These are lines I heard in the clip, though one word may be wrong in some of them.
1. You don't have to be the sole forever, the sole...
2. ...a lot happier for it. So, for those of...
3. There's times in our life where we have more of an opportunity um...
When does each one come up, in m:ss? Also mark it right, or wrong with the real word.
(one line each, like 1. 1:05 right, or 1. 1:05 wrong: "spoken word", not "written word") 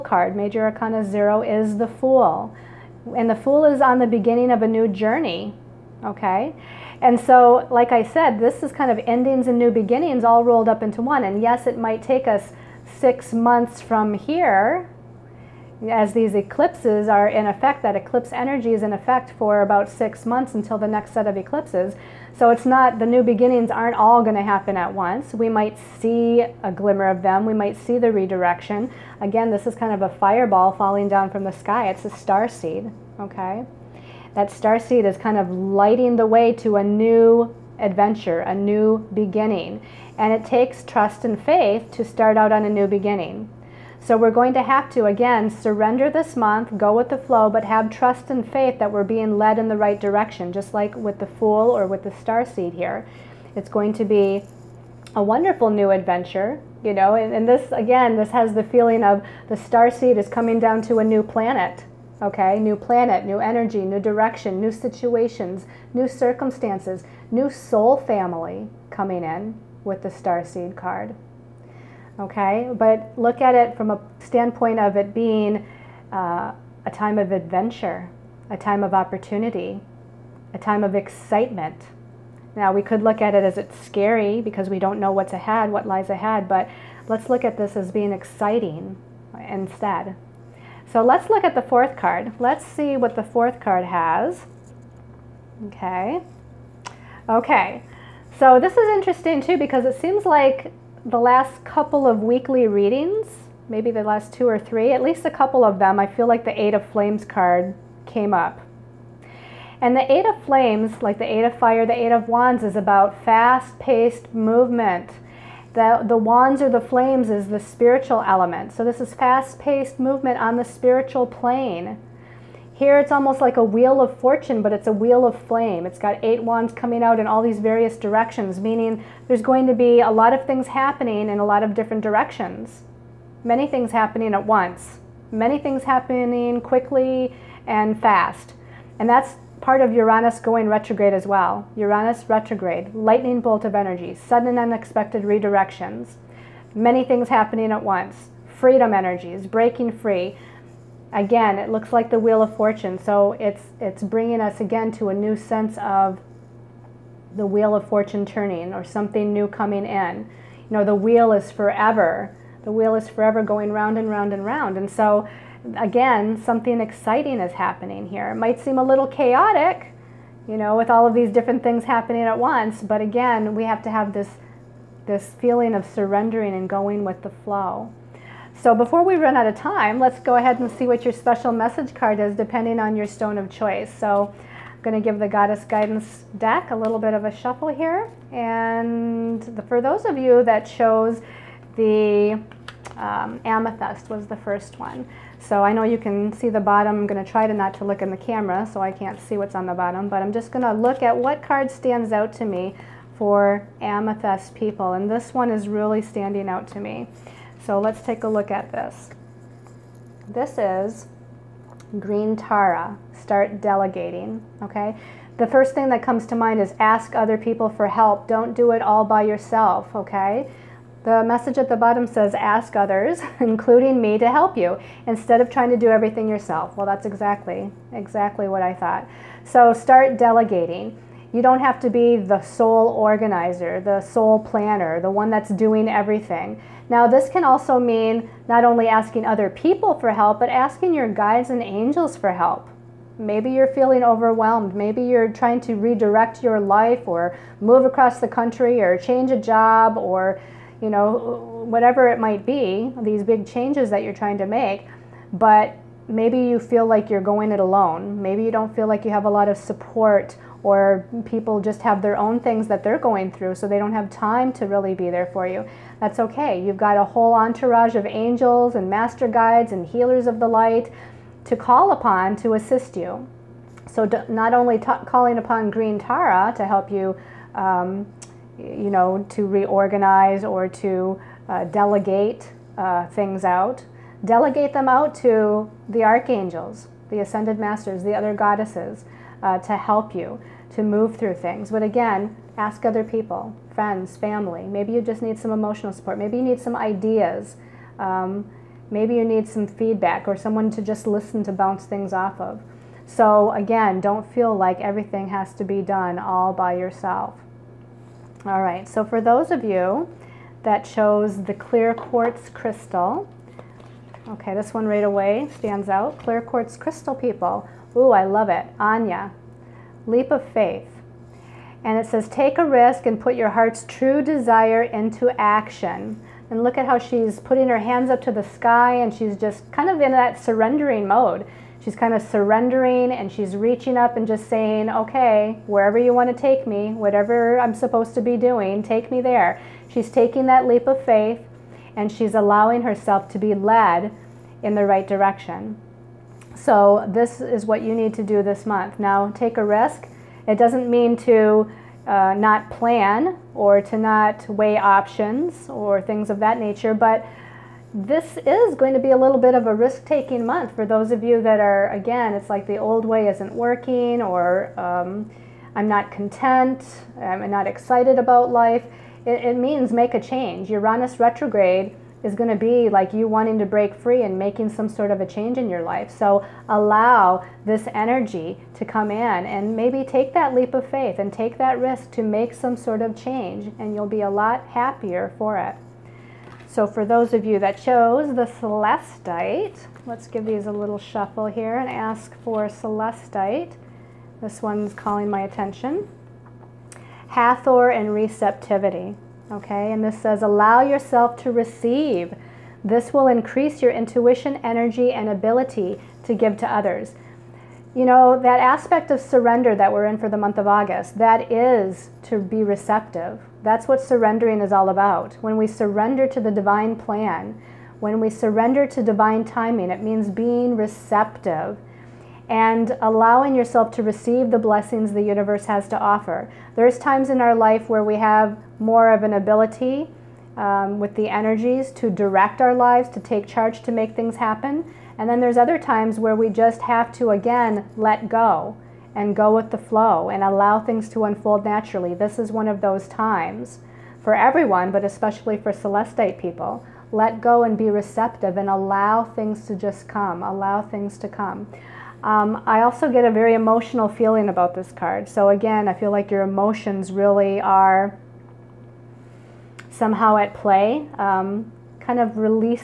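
1. 3:51 wrong: "organizer", not "forever"
2. 6:24 right
3. 7:06 wrong: "ability", not "opportunity".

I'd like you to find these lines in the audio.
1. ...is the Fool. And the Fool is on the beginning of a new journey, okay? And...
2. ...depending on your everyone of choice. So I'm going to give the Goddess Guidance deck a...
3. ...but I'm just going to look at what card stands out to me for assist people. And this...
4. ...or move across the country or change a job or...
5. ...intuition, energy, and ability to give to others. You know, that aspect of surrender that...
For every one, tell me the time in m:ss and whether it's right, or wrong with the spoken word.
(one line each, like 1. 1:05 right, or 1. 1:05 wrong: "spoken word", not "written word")
1. 0:01 right
2. 3:02 wrong: "stone", not "everyone"
3. 3:20 wrong: "amethyst", not "assist"
4. 4:07 right
5. 6:43 right.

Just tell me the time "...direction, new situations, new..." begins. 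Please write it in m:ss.
1:03.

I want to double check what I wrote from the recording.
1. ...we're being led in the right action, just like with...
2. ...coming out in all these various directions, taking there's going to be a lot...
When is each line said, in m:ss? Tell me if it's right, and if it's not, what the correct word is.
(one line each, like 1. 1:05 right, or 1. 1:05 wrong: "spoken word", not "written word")
1. 0:48 wrong: "direction", not "action"
2. 2:06 wrong: "meaning", not "taking".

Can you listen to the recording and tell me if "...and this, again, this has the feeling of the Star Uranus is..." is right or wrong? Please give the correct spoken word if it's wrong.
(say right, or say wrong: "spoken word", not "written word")
wrong: "Seed", not "Uranus".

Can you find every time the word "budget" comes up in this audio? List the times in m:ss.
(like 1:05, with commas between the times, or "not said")
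not said.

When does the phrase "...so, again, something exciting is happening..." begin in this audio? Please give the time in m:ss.
2:44.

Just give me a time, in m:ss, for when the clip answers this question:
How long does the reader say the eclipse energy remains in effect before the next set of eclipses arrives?
0:19.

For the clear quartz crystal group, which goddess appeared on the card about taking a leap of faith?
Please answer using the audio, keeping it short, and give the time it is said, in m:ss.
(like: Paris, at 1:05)
Aine, at 5:18.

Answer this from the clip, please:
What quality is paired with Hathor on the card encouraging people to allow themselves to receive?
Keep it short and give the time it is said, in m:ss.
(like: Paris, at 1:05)
Receptivity, at 6:38.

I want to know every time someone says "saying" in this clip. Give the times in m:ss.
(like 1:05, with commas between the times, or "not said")
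5:34.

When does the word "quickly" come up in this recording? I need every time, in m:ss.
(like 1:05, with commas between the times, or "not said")
2:16.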